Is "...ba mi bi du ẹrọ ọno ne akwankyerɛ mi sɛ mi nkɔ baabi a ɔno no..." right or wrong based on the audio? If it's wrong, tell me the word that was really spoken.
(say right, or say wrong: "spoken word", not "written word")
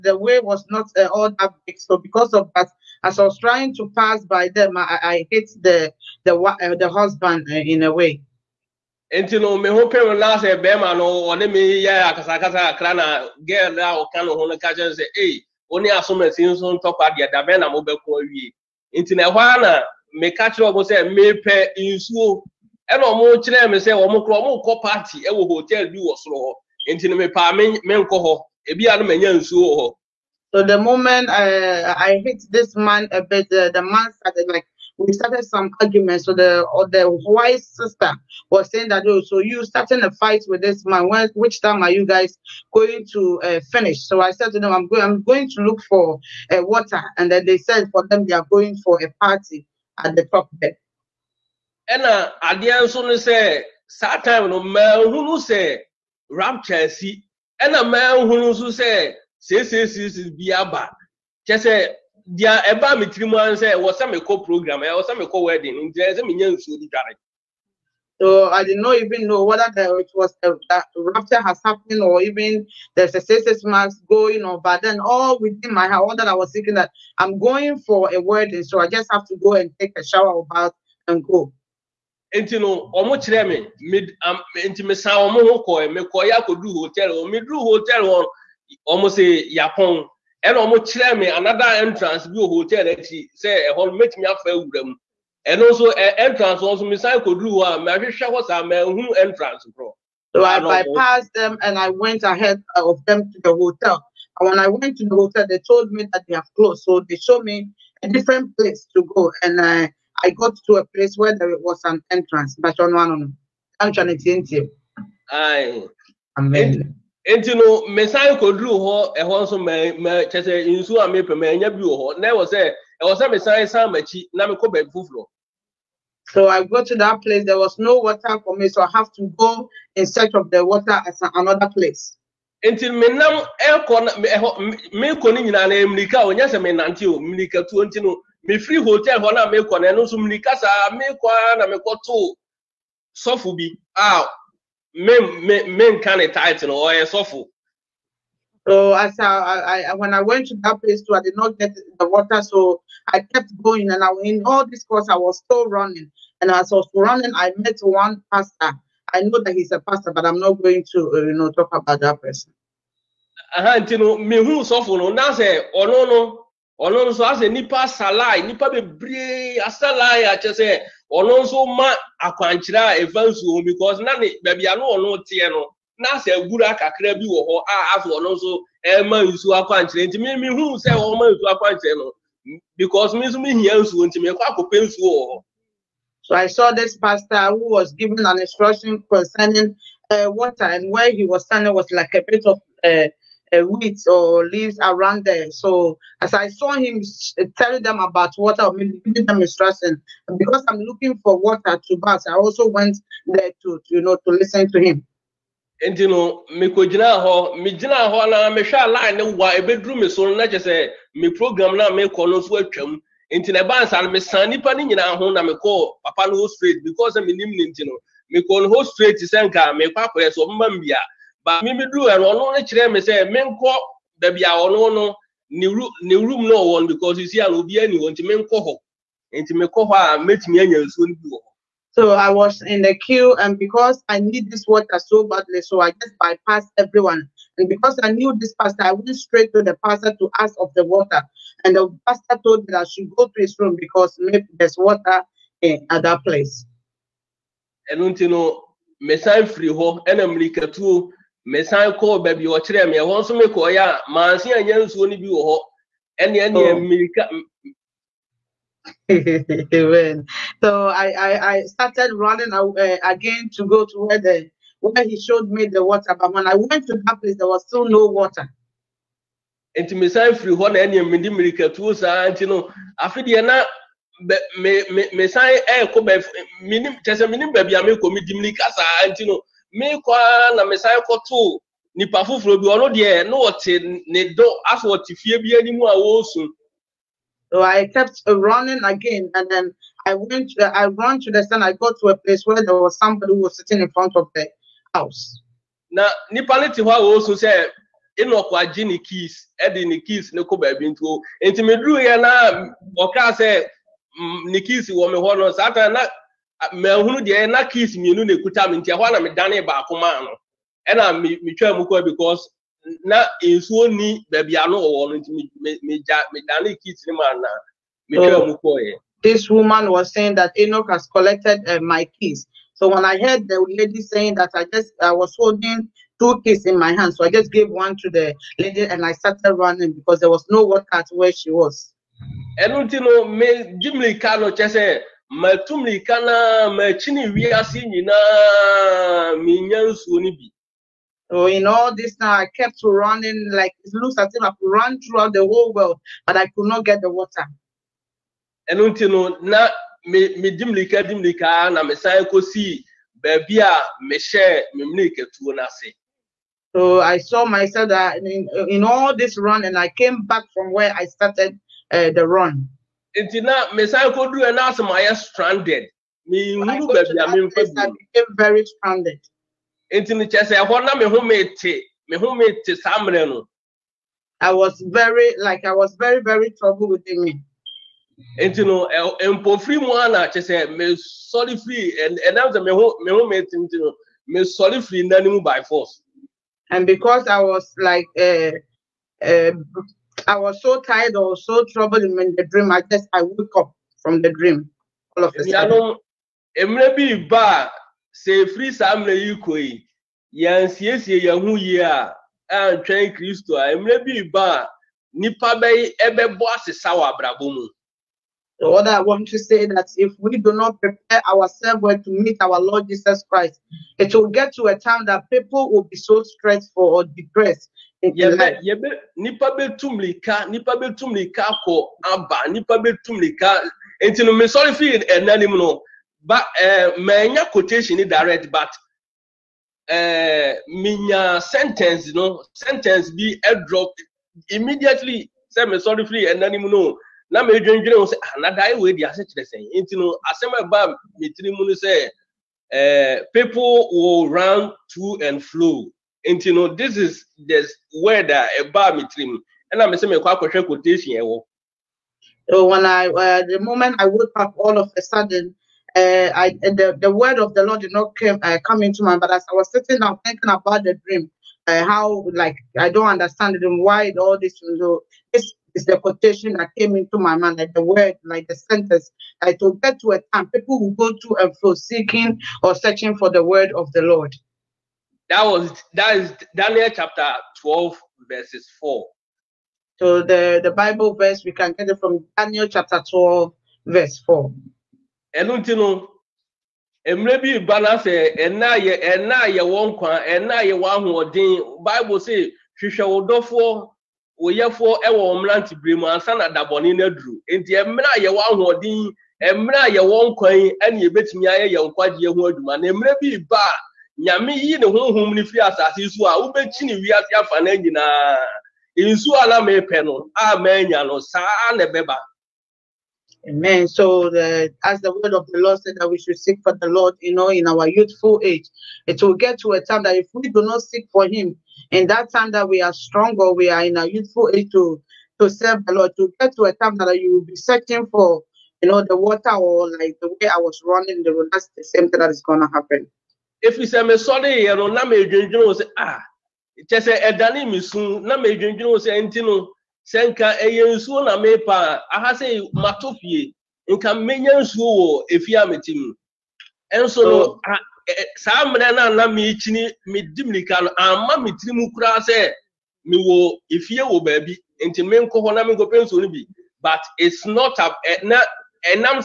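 wrong: "kyerɛ", not "akwankyerɛ".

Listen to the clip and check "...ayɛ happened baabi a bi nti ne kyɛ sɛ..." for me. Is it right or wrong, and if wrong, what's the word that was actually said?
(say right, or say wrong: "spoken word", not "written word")
wrong: "stranded", not "happened".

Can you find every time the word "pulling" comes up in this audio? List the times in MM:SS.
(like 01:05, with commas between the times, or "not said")
not said.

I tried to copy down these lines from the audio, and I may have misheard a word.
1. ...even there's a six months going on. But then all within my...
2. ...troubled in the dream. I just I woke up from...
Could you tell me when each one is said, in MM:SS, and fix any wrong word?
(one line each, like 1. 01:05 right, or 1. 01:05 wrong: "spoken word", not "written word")
1. 01:12 right
2. 06:31 right.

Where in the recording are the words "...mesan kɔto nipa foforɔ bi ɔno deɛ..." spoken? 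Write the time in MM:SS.
04:40.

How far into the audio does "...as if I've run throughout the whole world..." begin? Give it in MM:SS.
05:44.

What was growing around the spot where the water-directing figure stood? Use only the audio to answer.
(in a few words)
weeds or leaves.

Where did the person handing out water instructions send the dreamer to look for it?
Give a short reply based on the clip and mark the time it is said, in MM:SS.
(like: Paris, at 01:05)
his room, at 04:03.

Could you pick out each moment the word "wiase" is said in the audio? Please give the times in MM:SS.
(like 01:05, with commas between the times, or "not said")
05:37, 08:27.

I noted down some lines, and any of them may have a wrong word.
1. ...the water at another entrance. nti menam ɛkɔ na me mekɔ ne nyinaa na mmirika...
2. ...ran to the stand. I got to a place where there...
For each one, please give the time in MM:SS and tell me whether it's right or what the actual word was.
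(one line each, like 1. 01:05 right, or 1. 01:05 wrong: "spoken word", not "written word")
1. 02:10 wrong: "place", not "entrance"
2. 04:50 right.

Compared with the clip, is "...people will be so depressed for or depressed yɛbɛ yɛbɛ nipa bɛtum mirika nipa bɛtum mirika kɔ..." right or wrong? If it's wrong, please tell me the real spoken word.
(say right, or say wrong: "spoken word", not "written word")
wrong: "stressed", not "depressed".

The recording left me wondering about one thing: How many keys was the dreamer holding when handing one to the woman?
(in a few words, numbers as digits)
2.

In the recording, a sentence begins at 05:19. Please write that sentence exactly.
This woman was saying that Enoch has collected uh, my keys.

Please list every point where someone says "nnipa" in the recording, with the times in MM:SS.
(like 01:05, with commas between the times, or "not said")
03:34.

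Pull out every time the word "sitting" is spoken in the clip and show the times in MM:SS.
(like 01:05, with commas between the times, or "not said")
04:53, 07:39.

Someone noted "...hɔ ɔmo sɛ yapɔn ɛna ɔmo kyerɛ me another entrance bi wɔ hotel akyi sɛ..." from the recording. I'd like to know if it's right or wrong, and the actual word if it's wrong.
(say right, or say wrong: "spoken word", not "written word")
right.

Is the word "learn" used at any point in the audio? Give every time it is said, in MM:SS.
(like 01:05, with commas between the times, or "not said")
not said.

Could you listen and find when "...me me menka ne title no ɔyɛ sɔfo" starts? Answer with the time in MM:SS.
02:25.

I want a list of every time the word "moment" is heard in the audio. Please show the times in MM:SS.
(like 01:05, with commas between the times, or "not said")
00:30, 07:33.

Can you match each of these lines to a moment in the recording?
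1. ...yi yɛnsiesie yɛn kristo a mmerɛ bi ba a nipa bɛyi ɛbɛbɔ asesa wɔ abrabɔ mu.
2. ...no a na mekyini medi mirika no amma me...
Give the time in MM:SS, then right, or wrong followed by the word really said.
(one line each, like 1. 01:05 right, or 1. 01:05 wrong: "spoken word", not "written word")
1. 06:39 right
2. 09:08 right.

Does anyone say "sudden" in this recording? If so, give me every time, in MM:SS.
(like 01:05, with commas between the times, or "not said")
06:35, 07:35.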